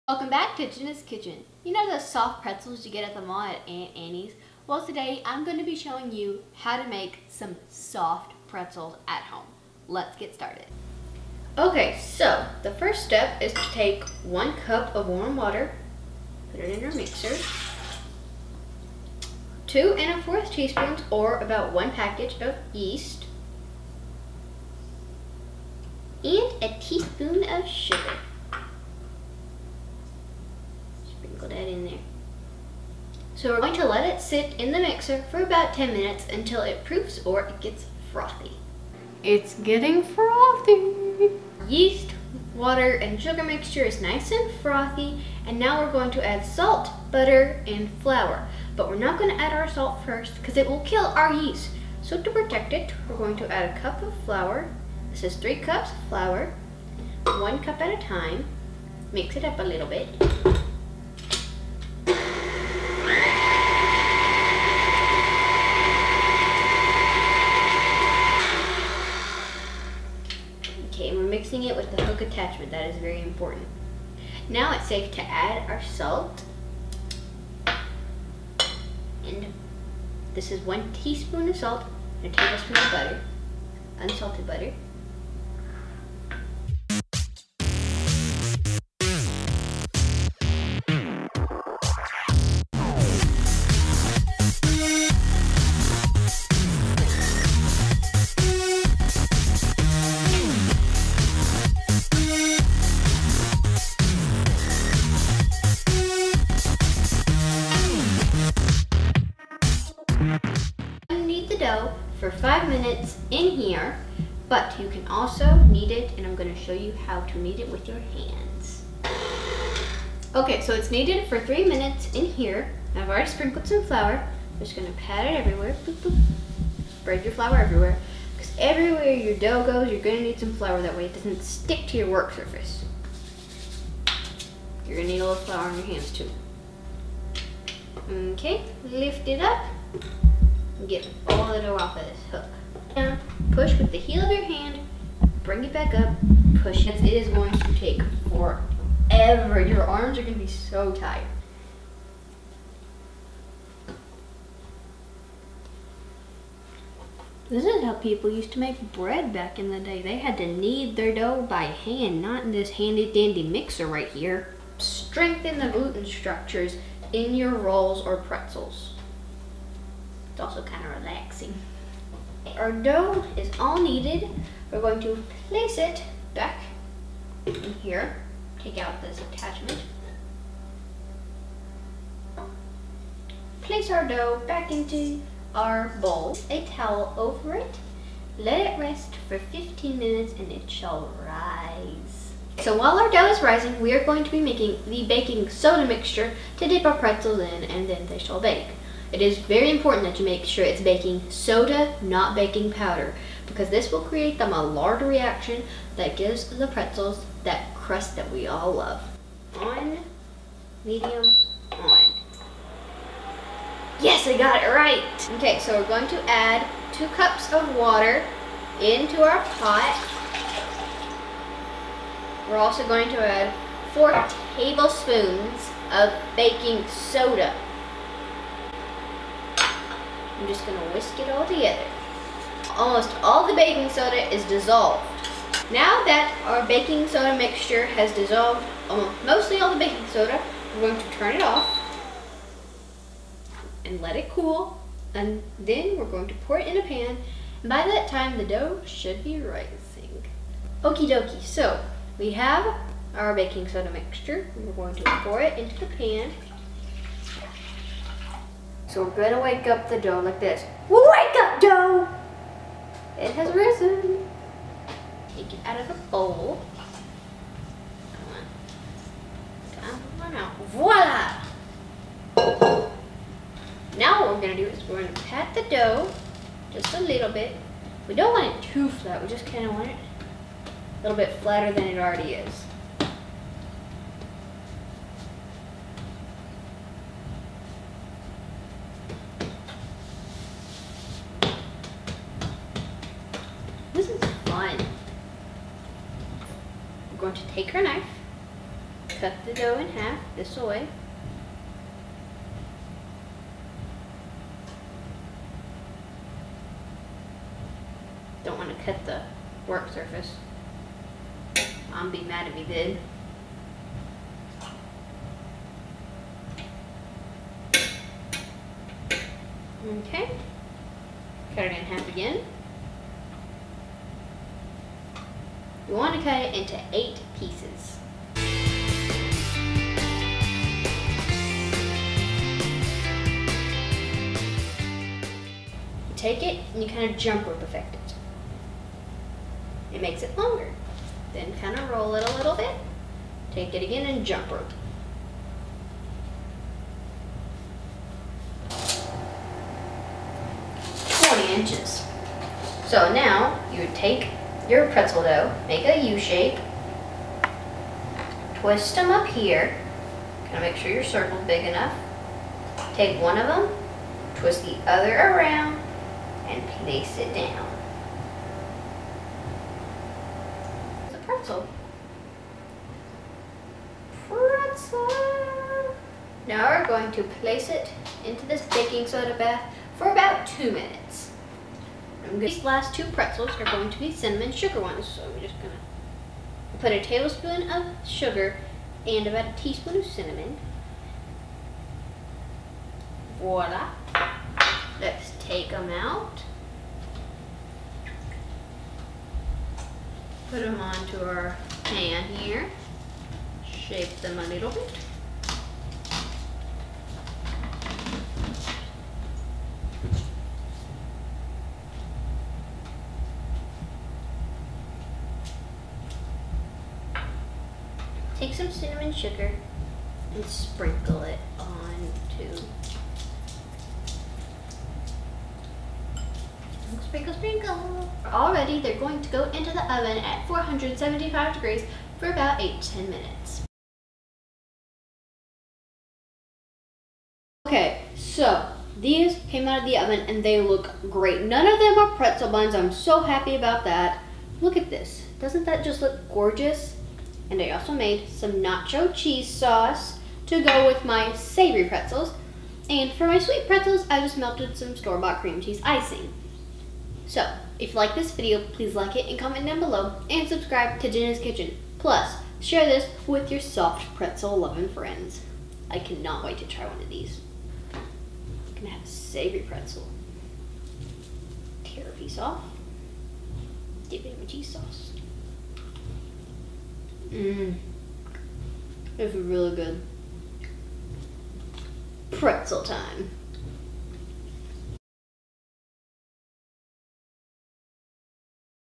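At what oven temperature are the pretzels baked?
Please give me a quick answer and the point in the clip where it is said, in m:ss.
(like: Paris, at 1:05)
475 degrees, at 7:10.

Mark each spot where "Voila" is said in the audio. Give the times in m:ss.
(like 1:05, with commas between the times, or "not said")
4:30, 6:33.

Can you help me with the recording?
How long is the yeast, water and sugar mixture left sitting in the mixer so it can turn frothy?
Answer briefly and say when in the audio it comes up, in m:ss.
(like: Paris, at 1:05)
10 minutes, at 0:35.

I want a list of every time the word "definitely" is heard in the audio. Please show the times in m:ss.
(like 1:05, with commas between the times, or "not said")
not said.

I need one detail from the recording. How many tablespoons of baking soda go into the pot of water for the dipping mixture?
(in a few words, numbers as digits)
4.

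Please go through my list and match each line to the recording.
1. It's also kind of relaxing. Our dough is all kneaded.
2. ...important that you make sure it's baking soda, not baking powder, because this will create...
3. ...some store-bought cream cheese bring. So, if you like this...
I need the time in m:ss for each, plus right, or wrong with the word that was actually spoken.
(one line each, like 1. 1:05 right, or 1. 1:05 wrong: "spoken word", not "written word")
1. 2:50 right
2. 3:19 right
3. 7:34 wrong: "icing", not "bring".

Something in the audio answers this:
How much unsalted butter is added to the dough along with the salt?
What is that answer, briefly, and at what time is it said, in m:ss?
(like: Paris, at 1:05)
1 tablespoon, at 1:22.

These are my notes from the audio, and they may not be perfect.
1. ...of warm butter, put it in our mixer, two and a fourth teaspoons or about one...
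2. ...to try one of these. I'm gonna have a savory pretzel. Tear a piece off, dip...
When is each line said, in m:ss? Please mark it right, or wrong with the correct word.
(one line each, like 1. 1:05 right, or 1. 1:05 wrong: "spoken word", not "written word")
1. 0:14 wrong: "water", not "butter"
2. 7:46 right.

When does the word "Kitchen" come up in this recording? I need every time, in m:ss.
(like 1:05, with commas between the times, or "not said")
0:01, 7:41.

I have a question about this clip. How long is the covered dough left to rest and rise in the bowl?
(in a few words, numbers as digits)
15 minutes.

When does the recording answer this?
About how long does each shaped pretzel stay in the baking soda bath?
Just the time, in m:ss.
6:20.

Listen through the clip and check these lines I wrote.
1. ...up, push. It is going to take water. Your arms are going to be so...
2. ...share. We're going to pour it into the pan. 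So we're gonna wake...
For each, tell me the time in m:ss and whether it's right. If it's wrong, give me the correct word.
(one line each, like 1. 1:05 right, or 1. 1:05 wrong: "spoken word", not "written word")
1. 2:25 wrong: "forever", not "water"
2. 4:13 wrong: "mixture", not "share".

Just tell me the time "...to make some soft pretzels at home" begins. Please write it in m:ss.
0:06.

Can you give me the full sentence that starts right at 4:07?
And by that time, the dough should be rising.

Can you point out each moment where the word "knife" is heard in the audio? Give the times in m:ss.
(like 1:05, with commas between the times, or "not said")
4:57.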